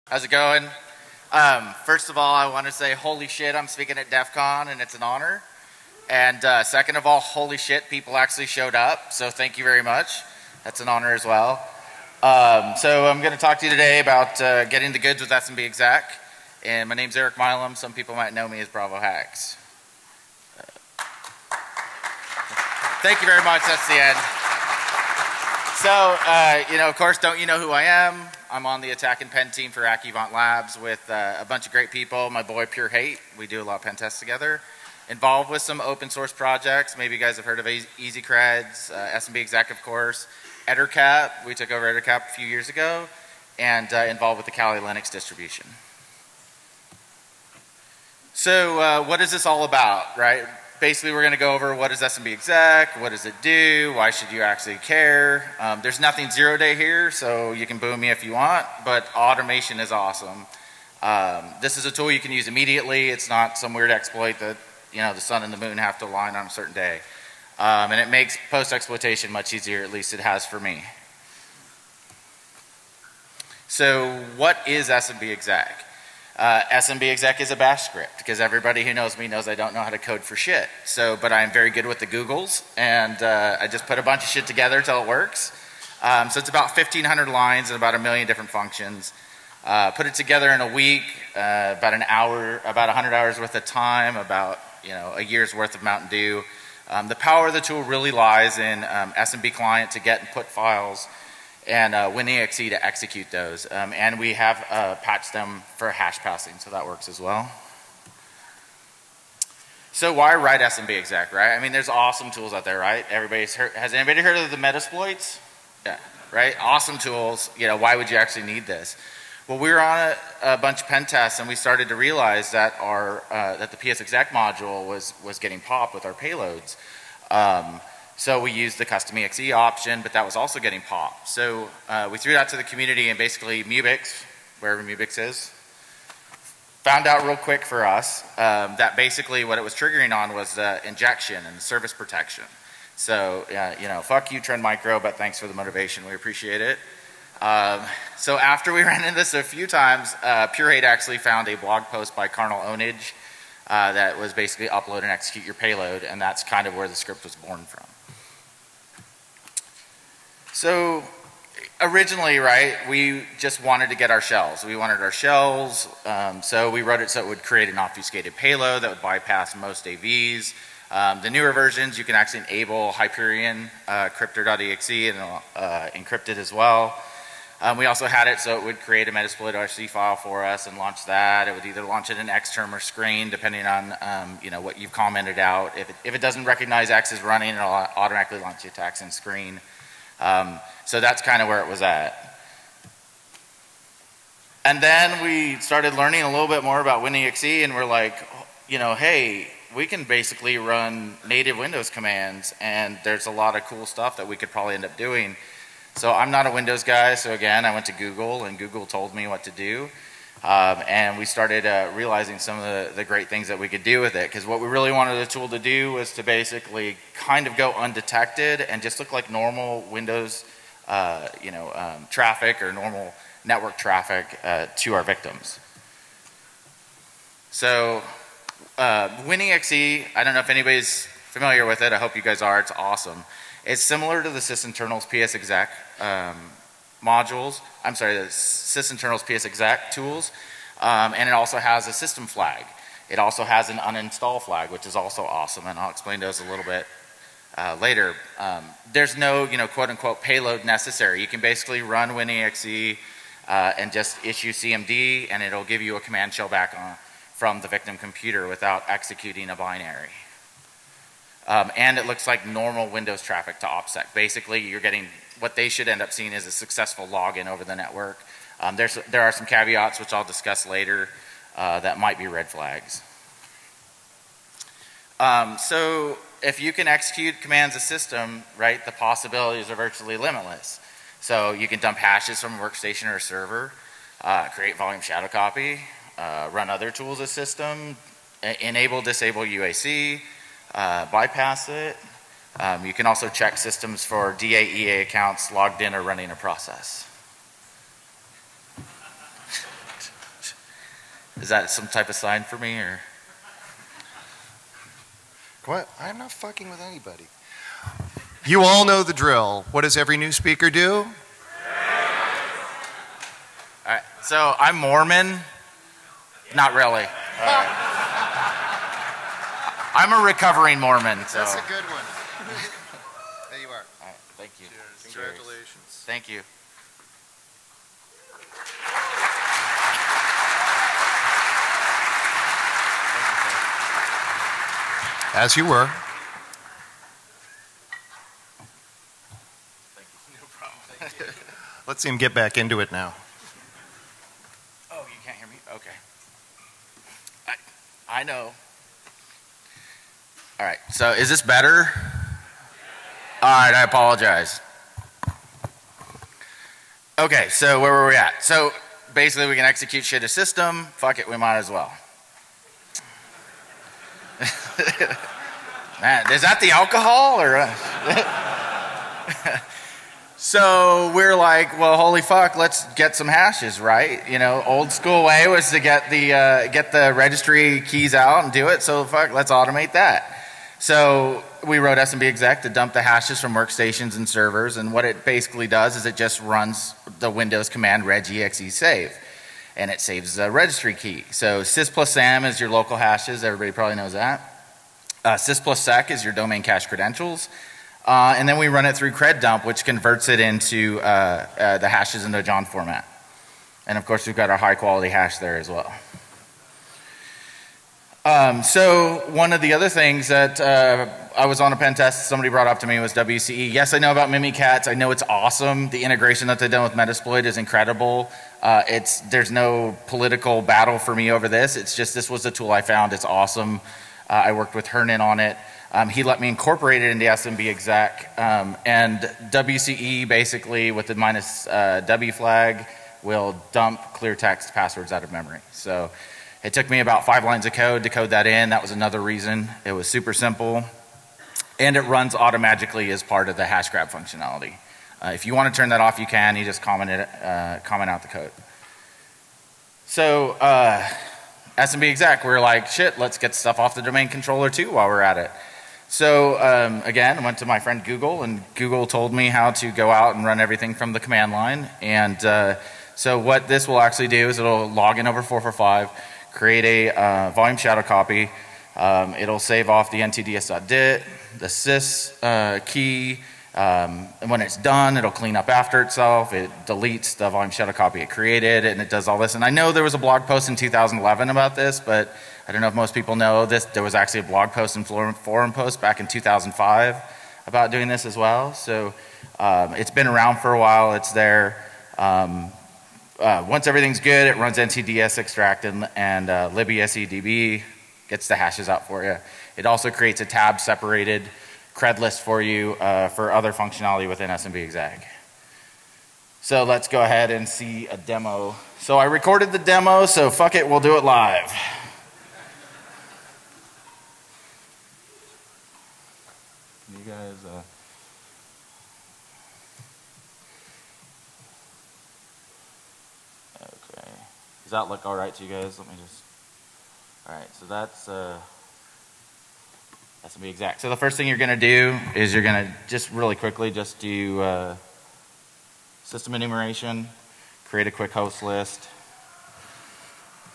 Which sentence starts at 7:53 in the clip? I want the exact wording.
Um, and when it's done, it'll clean up after itself.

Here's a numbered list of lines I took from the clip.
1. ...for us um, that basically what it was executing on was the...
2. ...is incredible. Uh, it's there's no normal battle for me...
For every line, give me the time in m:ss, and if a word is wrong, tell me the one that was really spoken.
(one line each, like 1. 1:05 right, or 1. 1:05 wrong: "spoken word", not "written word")
1. 2:17 wrong: "triggering", not "executing"
2. 6:57 wrong: "political", not "normal".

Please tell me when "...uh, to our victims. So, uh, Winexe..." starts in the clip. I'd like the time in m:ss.
3:44.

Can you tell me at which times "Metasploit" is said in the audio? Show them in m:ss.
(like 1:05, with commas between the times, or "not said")
1:54, 2:59, 6:56.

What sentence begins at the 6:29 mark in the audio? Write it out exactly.
And it saves a registry key.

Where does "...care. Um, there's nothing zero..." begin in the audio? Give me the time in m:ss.
0:54.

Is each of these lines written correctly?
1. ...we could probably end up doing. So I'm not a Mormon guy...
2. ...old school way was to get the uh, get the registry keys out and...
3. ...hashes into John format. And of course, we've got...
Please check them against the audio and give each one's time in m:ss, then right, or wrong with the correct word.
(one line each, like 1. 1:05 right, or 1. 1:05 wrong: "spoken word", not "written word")
1. 3:24 wrong: "Windows", not "Mormon"
2. 6:14 right
3. 6:41 right.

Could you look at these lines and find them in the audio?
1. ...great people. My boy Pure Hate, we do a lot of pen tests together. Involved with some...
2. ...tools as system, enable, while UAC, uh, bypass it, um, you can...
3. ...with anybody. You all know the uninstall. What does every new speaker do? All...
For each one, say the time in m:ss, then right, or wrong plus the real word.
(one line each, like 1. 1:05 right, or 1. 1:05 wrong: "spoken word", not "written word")
1. 0:31 right
2. 4:46 wrong: "disable", not "while"
3. 5:06 wrong: "drill", not "uninstall".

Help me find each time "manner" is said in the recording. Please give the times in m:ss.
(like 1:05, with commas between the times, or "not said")
not said.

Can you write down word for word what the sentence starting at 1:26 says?
Um, so it's about 1,500 lines and about a million different functions.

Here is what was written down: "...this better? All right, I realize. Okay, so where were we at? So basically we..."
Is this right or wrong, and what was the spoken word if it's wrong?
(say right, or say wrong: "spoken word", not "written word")
wrong: "apologize", not "realize".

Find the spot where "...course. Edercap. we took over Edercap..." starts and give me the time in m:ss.
0:39.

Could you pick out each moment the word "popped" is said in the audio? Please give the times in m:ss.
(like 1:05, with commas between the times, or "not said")
2:05, 2:10.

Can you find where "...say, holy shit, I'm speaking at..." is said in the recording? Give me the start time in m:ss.
0:02.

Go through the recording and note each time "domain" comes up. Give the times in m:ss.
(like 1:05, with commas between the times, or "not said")
6:36, 7:34.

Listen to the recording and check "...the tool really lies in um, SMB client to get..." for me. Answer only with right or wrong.
right.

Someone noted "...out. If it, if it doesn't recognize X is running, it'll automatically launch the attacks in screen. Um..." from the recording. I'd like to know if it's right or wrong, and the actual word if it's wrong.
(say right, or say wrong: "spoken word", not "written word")
right.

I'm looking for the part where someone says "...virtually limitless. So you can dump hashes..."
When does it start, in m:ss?
4:39.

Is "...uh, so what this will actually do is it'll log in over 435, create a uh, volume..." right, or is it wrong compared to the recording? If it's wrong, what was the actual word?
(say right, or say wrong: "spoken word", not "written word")
wrong: "445", not "435".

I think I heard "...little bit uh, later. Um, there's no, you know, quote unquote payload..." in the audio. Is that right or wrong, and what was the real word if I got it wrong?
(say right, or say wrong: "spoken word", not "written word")
right.